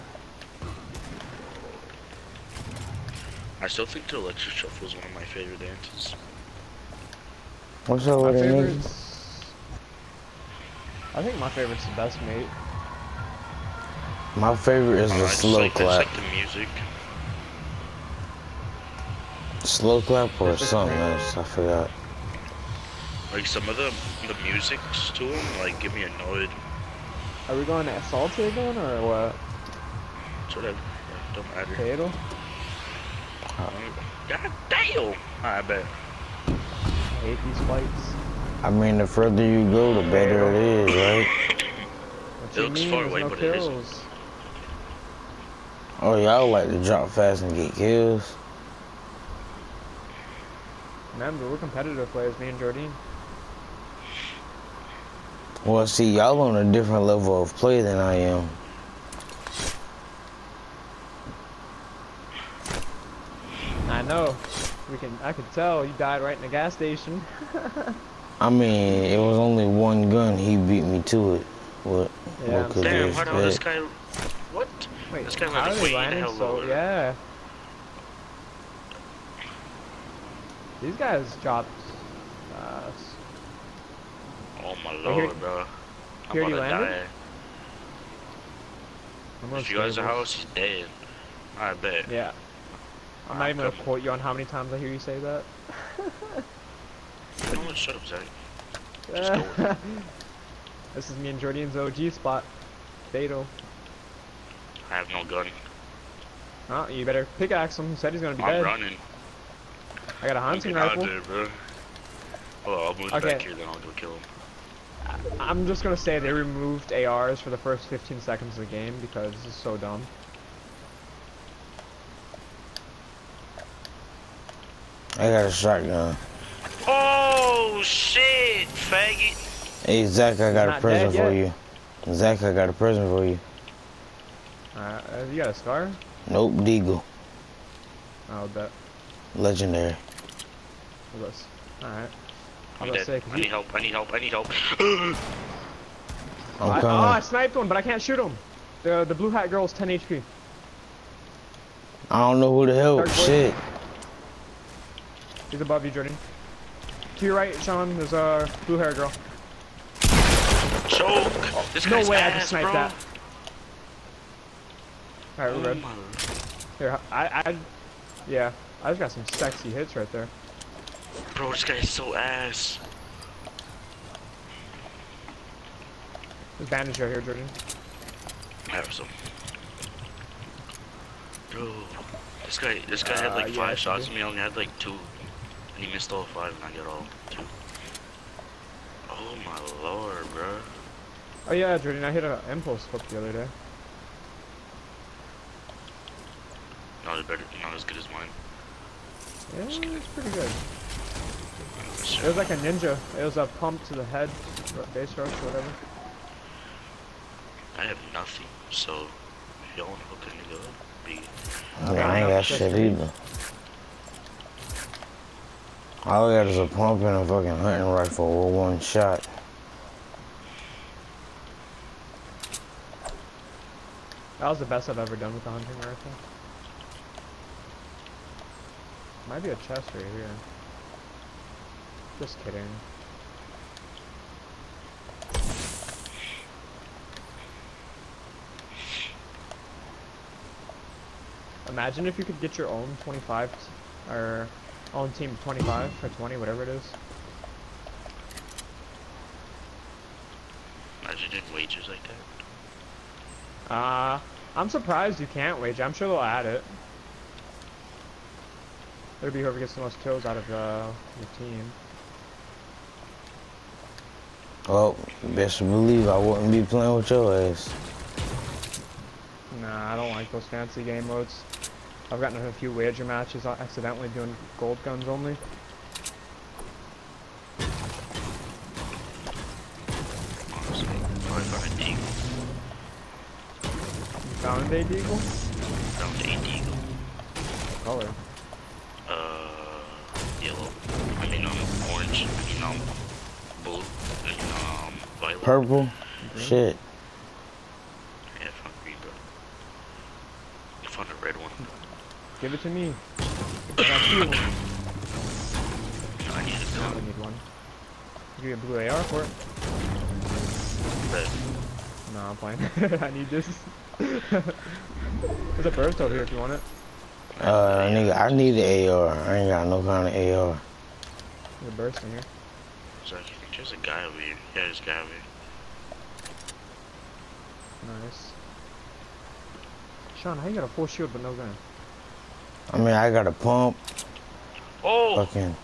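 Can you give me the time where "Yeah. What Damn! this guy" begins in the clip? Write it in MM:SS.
01:12.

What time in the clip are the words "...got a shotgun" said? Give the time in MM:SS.
02:05.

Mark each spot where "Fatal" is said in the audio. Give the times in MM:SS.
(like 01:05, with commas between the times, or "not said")
00:31, 01:43.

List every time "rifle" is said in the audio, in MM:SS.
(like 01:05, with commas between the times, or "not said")
01:50, 03:37, 03:45.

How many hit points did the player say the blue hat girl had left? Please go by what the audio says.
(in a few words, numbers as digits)
10.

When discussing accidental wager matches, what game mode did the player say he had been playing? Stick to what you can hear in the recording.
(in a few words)
gold guns only.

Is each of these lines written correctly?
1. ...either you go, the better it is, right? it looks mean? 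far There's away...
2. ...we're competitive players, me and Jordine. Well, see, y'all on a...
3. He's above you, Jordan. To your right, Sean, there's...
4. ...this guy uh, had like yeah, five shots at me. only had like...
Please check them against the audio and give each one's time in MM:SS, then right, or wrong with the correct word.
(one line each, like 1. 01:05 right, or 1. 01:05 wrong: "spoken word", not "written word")
1. 00:39 wrong: "further", not "either"
2. 00:51 right
3. 02:35 right
4. 03:02 right.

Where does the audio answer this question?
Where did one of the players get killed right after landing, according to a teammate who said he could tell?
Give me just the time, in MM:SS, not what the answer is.
01:06.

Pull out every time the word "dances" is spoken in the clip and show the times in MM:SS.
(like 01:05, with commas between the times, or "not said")
00:05.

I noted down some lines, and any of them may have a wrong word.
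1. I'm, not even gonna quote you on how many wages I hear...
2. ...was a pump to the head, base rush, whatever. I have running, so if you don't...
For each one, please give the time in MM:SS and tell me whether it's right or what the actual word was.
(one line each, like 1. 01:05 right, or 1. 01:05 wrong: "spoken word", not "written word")
1. 01:33 wrong: "times", not "wages"
2. 03:23 wrong: "nothing", not "running".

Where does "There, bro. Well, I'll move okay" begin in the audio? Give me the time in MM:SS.
01:51.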